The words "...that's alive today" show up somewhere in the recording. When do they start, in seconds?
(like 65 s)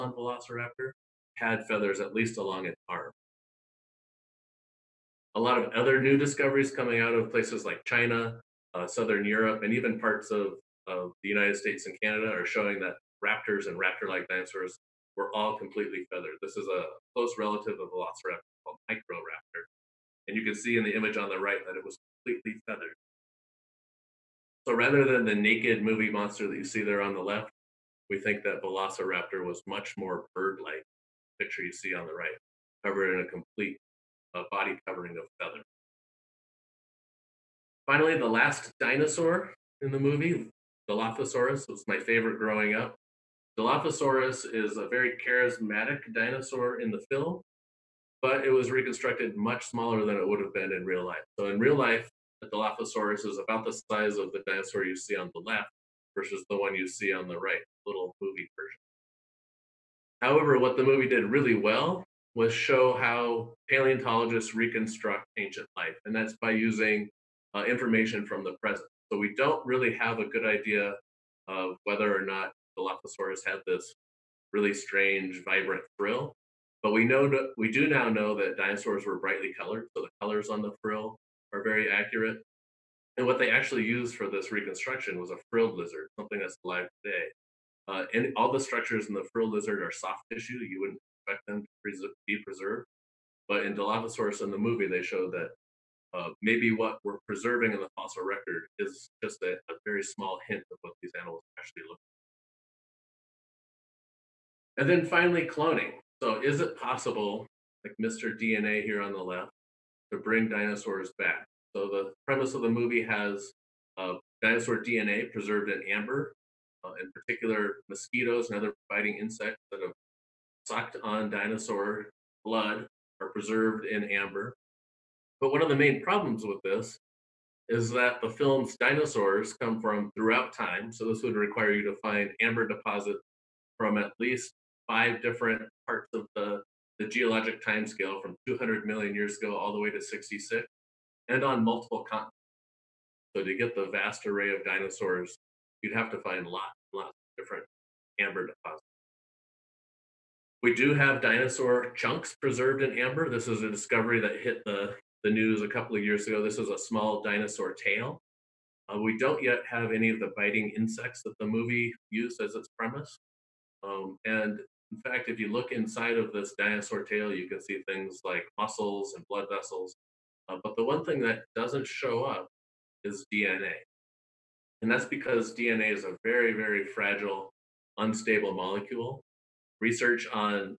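86 s.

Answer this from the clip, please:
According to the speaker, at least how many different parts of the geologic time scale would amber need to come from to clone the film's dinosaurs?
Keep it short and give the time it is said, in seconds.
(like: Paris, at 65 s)
5, at 134 s.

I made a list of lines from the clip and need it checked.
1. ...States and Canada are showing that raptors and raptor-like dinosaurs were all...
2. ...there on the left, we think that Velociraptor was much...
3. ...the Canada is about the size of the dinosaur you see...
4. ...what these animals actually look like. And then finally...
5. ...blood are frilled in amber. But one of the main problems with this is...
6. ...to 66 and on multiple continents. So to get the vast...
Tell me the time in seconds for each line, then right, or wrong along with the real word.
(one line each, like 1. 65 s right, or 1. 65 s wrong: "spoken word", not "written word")
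1. 11 s right
2. 26 s right
3. 52 s wrong: "Dilophosaurus", not "Canada"
4. 100 s right
5. 122 s wrong: "preserved", not "frilled"
6. 139 s right.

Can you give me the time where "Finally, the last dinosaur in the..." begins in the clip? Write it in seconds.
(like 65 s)
37 s.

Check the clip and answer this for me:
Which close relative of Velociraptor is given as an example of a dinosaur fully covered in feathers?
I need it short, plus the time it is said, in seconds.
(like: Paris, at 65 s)
Microraptor, at 18 s.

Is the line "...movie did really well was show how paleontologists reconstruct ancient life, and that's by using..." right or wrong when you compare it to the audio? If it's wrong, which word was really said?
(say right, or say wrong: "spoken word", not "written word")
right.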